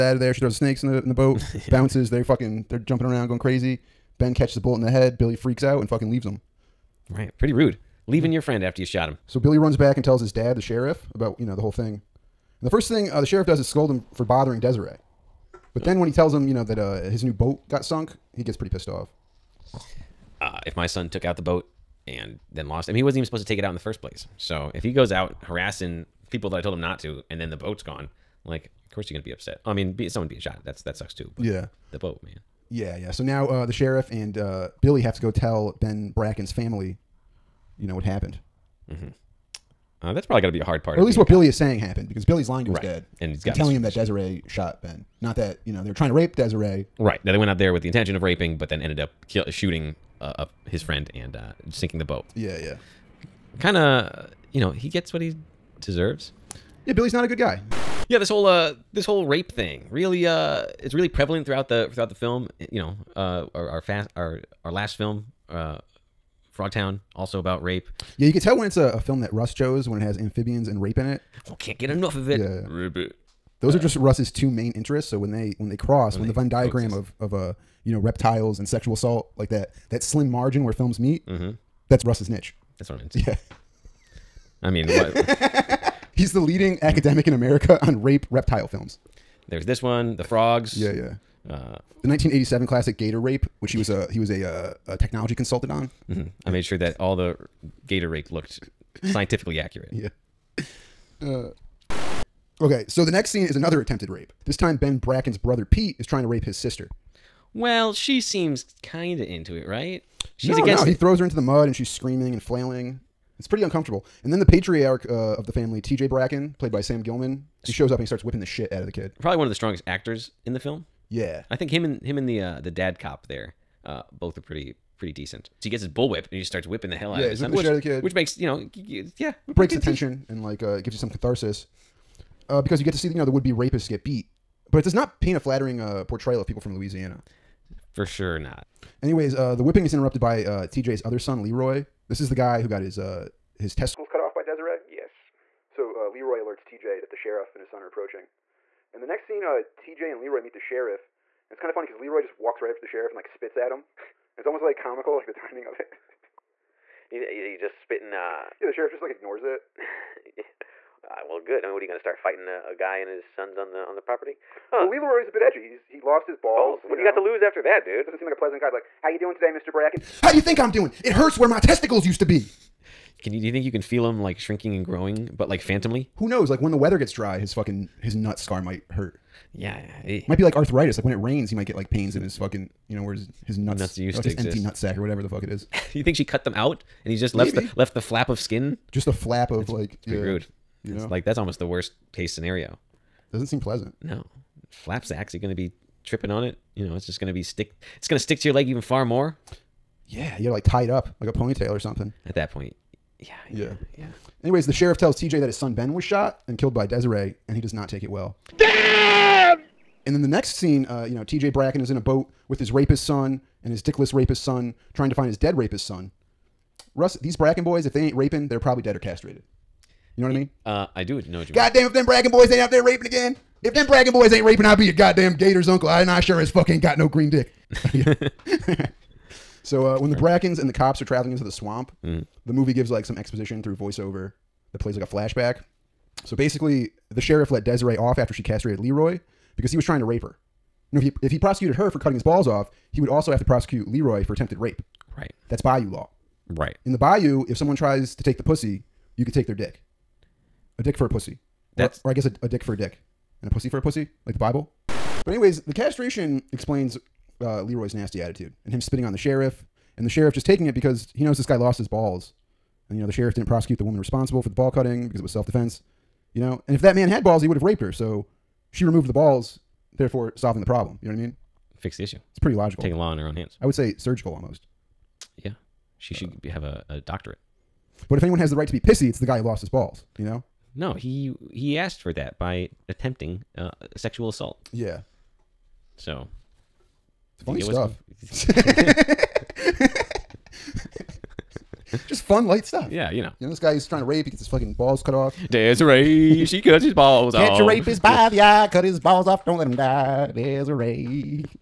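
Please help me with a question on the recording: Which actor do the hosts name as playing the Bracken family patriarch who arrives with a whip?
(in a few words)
Sam Gilman.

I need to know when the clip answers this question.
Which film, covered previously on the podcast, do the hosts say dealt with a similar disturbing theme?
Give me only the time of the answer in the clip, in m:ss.
1:06.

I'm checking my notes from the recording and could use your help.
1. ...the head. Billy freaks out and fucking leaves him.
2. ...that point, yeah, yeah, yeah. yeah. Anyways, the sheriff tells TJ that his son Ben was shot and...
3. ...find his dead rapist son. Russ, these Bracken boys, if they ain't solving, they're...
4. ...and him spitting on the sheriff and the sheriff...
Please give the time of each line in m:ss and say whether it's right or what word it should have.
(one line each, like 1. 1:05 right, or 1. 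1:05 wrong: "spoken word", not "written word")
1. 0:04 right
2. 3:22 right
3. 3:35 wrong: "raping", not "solving"
4. 4:18 right.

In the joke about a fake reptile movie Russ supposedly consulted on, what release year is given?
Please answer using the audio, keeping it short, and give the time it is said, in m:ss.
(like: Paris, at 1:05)
1987, at 1:32.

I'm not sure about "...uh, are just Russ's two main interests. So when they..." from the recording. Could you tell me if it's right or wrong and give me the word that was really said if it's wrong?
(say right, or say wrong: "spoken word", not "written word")
right.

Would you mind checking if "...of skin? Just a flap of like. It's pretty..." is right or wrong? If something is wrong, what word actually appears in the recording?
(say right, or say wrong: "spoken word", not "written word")
right.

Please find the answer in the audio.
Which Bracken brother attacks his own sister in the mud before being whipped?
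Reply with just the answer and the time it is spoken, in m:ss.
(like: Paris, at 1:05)
Pete, at 1:45.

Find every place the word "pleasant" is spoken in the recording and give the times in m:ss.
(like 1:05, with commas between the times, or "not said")
2:48, 3:13.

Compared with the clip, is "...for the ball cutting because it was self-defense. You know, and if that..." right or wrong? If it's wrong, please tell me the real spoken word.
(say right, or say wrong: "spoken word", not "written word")
right.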